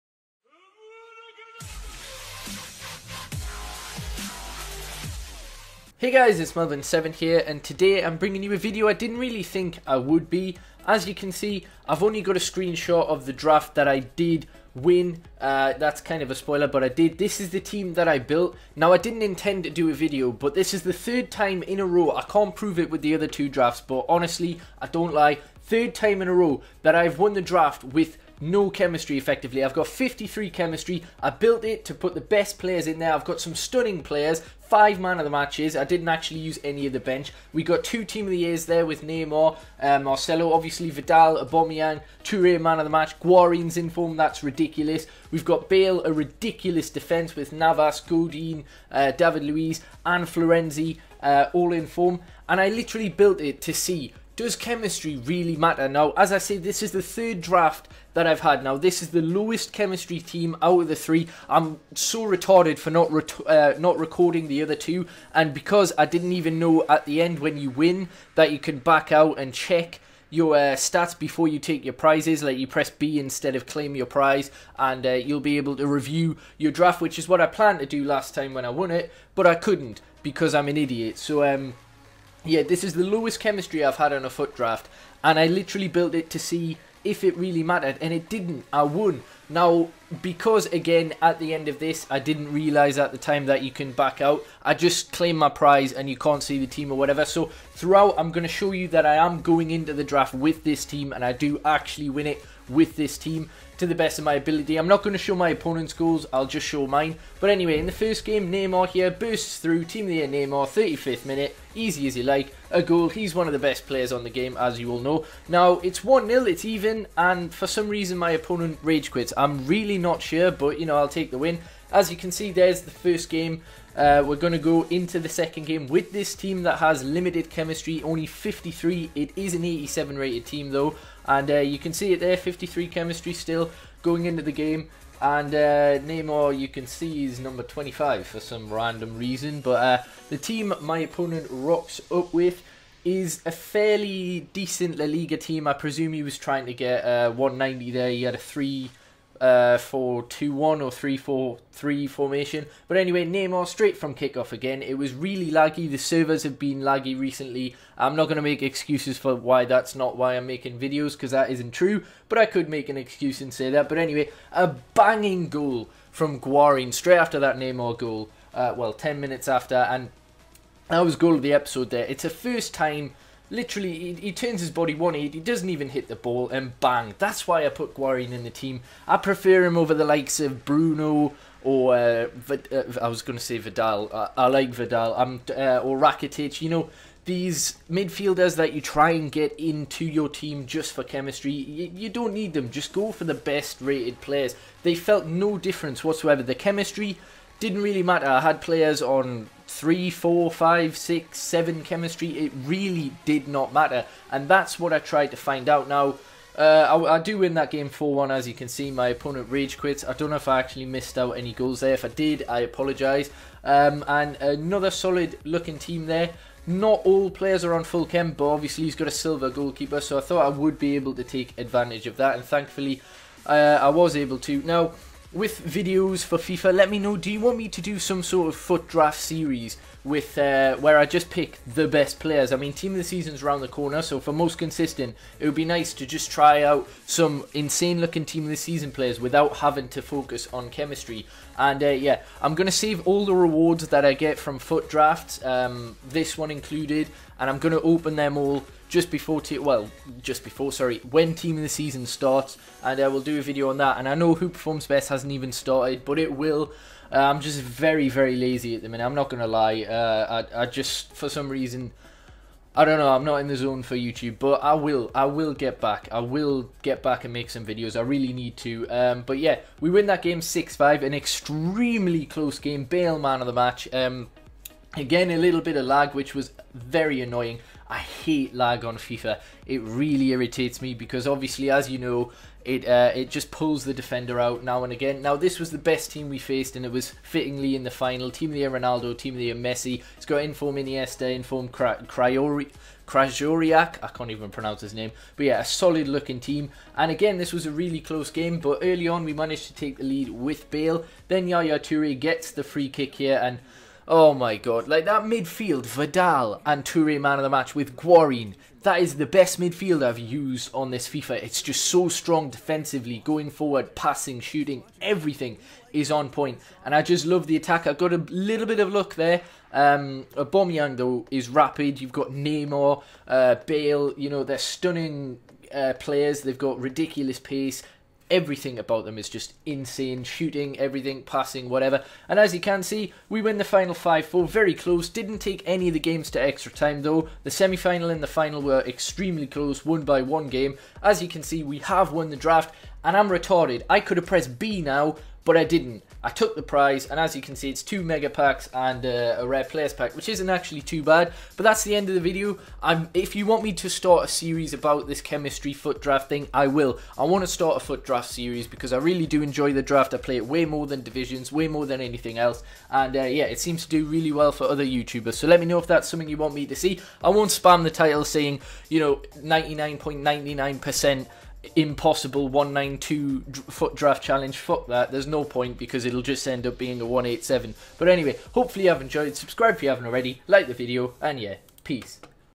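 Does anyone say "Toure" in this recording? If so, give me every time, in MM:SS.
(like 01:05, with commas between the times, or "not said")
00:42, 05:01, 05:06.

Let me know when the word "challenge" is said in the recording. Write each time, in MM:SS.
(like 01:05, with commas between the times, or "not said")
06:14.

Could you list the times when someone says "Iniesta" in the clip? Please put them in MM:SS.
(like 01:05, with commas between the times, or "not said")
04:50.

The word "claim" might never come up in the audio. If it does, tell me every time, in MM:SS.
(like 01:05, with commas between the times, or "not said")
01:13, 01:35.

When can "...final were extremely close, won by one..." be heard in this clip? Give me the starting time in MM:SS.
05:38.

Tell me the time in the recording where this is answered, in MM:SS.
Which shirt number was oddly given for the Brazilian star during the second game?
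02:17.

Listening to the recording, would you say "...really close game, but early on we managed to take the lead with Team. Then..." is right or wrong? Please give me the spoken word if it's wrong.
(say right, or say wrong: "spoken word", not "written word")
wrong: "Bale", not "Team".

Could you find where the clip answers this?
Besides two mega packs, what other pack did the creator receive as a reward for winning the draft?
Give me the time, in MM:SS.
05:49.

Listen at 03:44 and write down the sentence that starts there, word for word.
Now, with videos for FIFA, let me know.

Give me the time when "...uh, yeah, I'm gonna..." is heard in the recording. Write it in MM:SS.
04:01.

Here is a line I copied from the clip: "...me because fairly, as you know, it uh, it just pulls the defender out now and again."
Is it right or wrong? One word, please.
wrong.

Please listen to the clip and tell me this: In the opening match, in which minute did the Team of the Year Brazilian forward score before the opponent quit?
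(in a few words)
35th.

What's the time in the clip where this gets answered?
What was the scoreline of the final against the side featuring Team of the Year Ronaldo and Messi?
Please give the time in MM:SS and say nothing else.
05:33.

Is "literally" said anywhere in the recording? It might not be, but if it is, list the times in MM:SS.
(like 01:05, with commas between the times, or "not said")
00:52, 01:25, 02:53.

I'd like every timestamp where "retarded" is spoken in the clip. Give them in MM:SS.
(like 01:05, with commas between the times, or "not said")
01:02, 05:43.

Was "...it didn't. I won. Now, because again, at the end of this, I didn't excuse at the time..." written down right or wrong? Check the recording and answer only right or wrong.
wrong.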